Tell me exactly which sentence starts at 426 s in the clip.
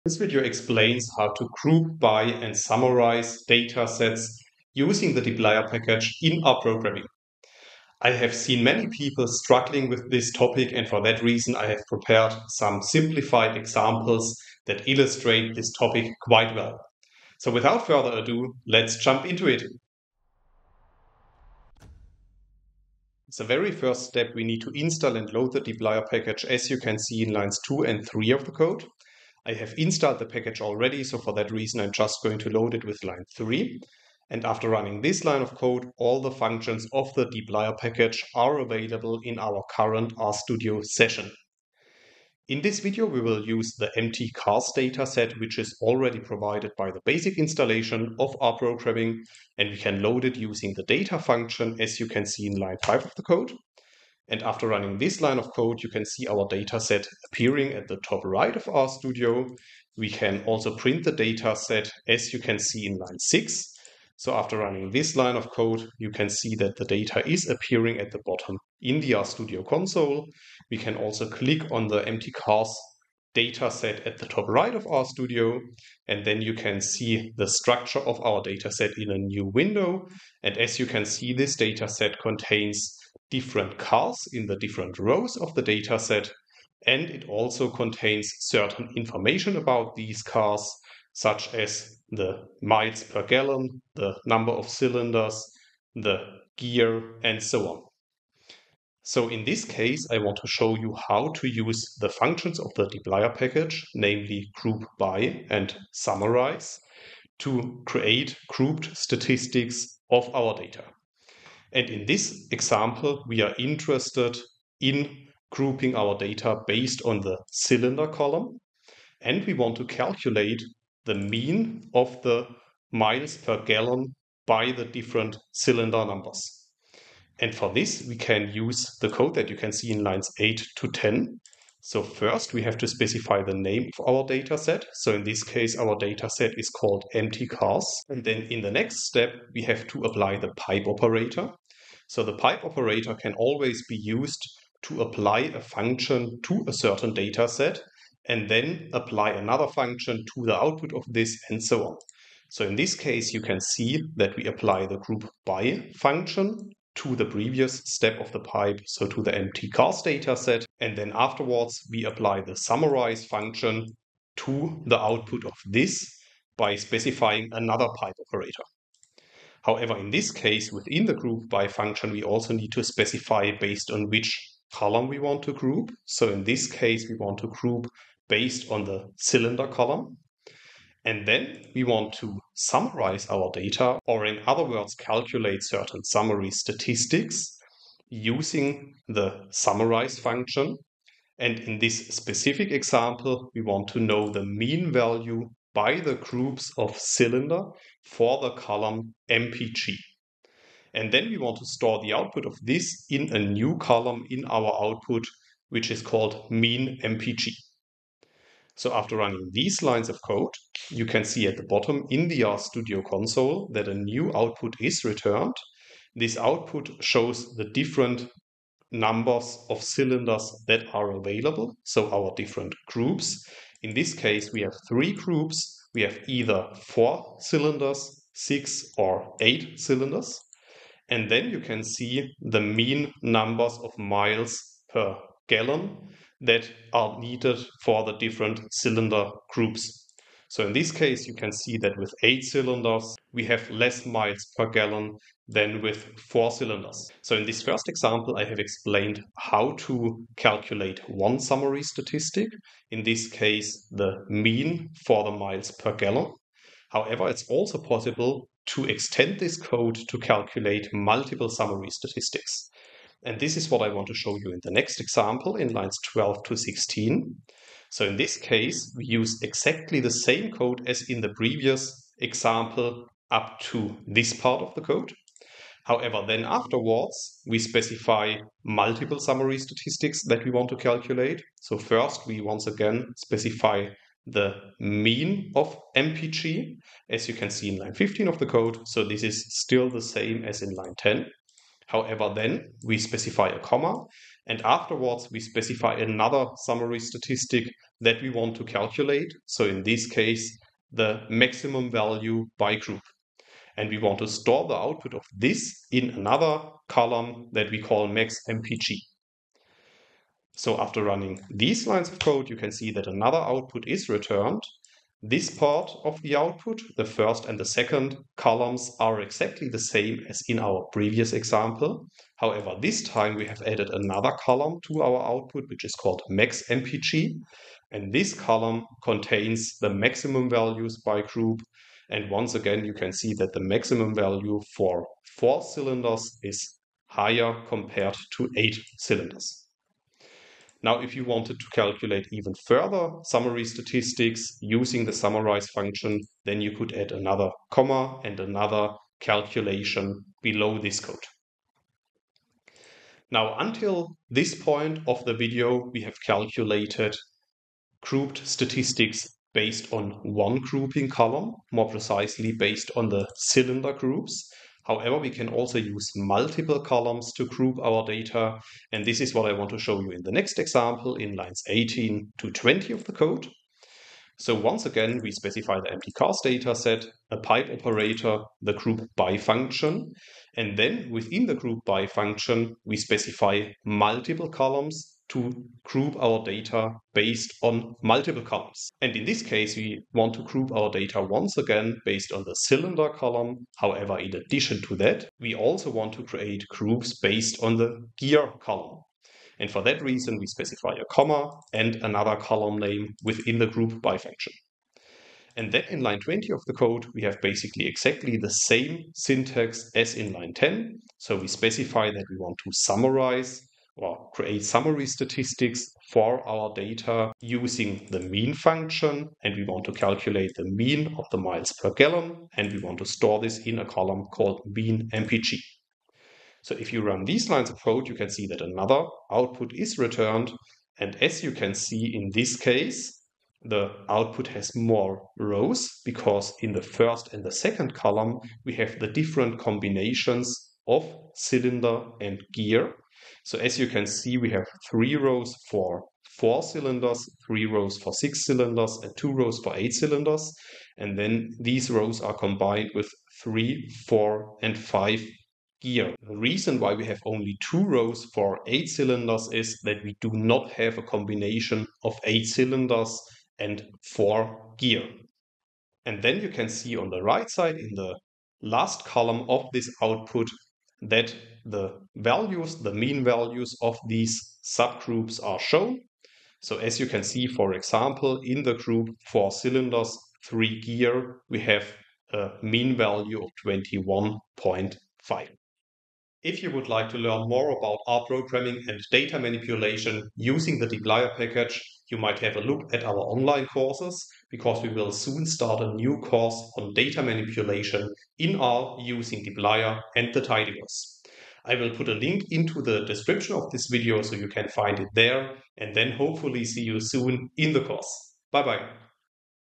So if you run these lines of code, you can see that another output is returned.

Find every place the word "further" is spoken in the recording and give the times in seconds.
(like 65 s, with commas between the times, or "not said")
17 s, 342 s.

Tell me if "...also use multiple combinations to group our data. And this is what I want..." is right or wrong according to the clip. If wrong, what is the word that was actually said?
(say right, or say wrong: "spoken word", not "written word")
wrong: "columns", not "combinations".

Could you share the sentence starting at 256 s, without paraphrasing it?
However, it's also possible to extend this code to calculate multiple summary statistics.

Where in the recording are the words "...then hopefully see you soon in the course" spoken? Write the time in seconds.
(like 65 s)
505 s.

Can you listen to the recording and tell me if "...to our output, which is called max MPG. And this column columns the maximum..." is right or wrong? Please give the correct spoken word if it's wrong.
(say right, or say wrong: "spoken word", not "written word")
wrong: "contains", not "columns".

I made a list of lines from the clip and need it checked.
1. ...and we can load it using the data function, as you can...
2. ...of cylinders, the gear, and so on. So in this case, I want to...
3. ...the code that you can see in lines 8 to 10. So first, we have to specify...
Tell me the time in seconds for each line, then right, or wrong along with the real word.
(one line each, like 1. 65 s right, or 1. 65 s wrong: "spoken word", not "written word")
1. 49 s right
2. 94 s right
3. 128 s right.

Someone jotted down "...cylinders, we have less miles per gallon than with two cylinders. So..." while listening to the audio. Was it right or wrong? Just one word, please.
wrong.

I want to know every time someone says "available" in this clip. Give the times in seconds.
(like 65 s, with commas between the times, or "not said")
38 s, 221 s.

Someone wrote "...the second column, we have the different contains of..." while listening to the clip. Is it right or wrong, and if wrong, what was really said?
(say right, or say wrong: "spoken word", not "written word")
wrong: "combinations", not "contains".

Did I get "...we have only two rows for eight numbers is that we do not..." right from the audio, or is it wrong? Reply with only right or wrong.
wrong.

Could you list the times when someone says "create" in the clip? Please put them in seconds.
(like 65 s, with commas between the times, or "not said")
107 s, 396 s, 414 s.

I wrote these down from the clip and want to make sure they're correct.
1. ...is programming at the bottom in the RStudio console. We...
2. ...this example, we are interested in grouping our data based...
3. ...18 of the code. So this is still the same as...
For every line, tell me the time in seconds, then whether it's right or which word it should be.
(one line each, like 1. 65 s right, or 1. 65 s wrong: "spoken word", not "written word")
1. 67 s wrong: "appearing", not "programming"
2. 112 s right
3. 287 s wrong: "15", not "18".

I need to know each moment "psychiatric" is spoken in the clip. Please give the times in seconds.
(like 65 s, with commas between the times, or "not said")
not said.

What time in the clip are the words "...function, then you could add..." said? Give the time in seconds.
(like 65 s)
345 s.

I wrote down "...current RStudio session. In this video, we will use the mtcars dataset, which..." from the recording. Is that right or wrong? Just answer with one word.
right.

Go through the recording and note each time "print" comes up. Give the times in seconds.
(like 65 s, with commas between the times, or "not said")
60 s.